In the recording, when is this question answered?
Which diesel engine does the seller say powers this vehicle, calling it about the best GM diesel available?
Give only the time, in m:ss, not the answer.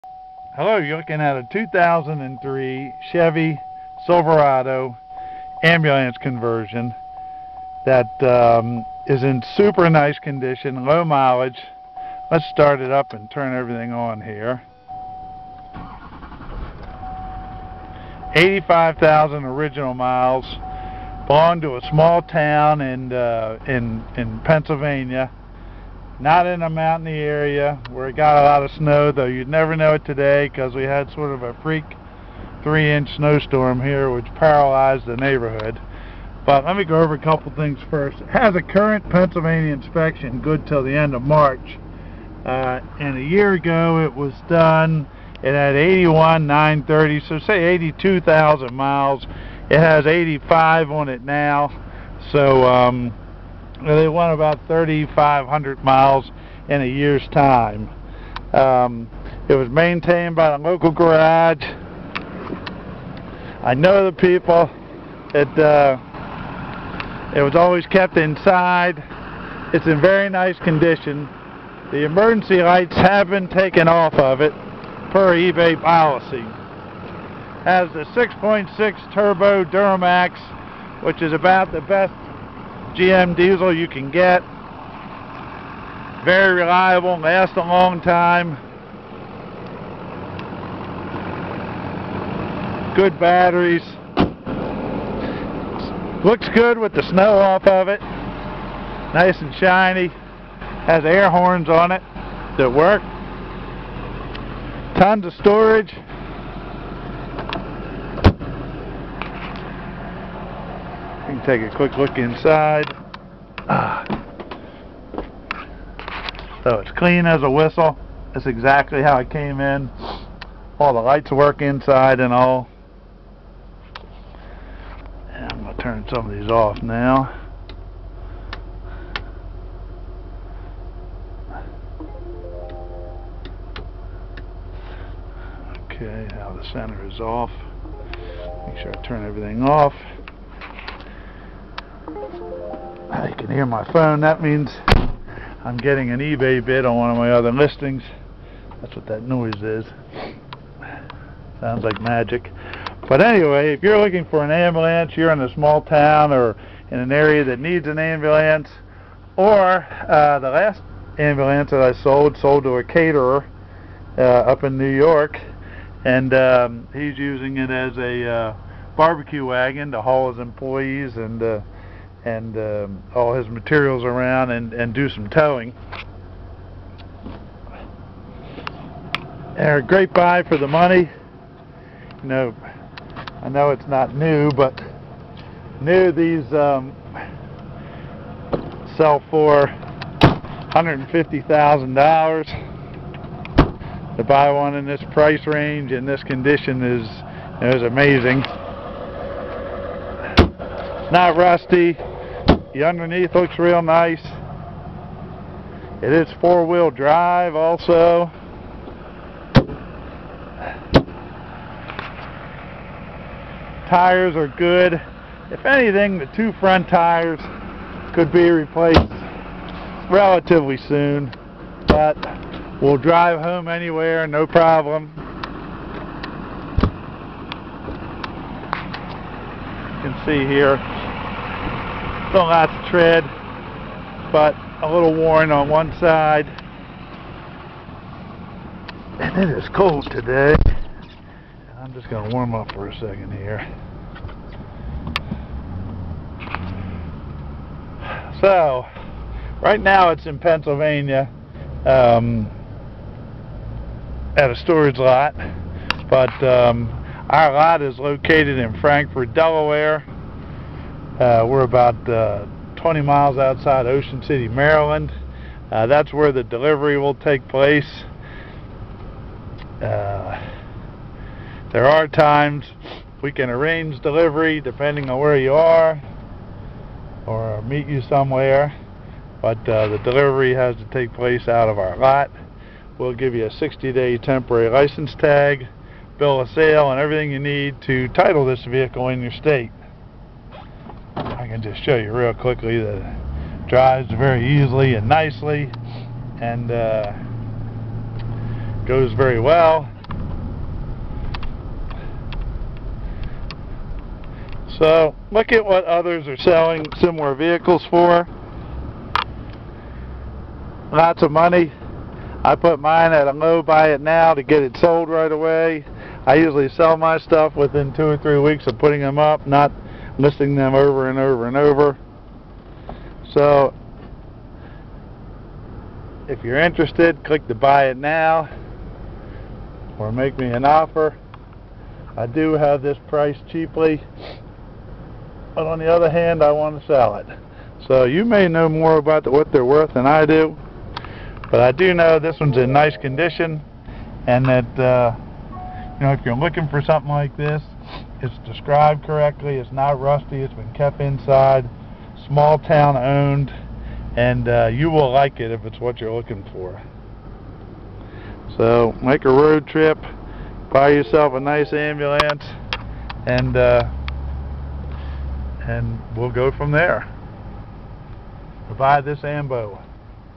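1:18.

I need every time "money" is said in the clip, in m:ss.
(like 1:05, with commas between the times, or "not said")
3:00, 5:11.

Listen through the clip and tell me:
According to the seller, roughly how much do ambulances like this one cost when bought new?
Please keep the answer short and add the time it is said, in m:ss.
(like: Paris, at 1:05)
$150,000, at 3:10.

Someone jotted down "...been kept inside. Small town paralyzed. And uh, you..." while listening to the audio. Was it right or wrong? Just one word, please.
wrong.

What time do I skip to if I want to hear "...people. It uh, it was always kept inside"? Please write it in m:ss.
1:04.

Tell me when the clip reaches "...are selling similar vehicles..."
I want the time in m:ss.
5:06.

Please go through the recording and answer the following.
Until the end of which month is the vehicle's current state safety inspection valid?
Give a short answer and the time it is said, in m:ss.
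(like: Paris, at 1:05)
March, at 0:41.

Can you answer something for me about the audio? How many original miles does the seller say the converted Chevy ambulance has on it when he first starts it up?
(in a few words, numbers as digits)
85,000.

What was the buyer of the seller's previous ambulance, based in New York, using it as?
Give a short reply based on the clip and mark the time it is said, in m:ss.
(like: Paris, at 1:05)
barbecue wagon, at 2:48.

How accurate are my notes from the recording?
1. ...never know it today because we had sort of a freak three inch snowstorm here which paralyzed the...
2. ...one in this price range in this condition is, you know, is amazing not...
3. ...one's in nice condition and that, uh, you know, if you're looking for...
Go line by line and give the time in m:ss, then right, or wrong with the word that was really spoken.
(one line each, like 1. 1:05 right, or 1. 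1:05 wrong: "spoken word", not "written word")
1. 0:29 right
2. 3:14 right
3. 5:42 right.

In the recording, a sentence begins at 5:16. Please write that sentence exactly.
I usually sell my stuff within two or three weeks of putting them up, not missing them over and over and over.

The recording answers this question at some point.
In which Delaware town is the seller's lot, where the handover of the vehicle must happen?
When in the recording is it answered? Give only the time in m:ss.
4:18.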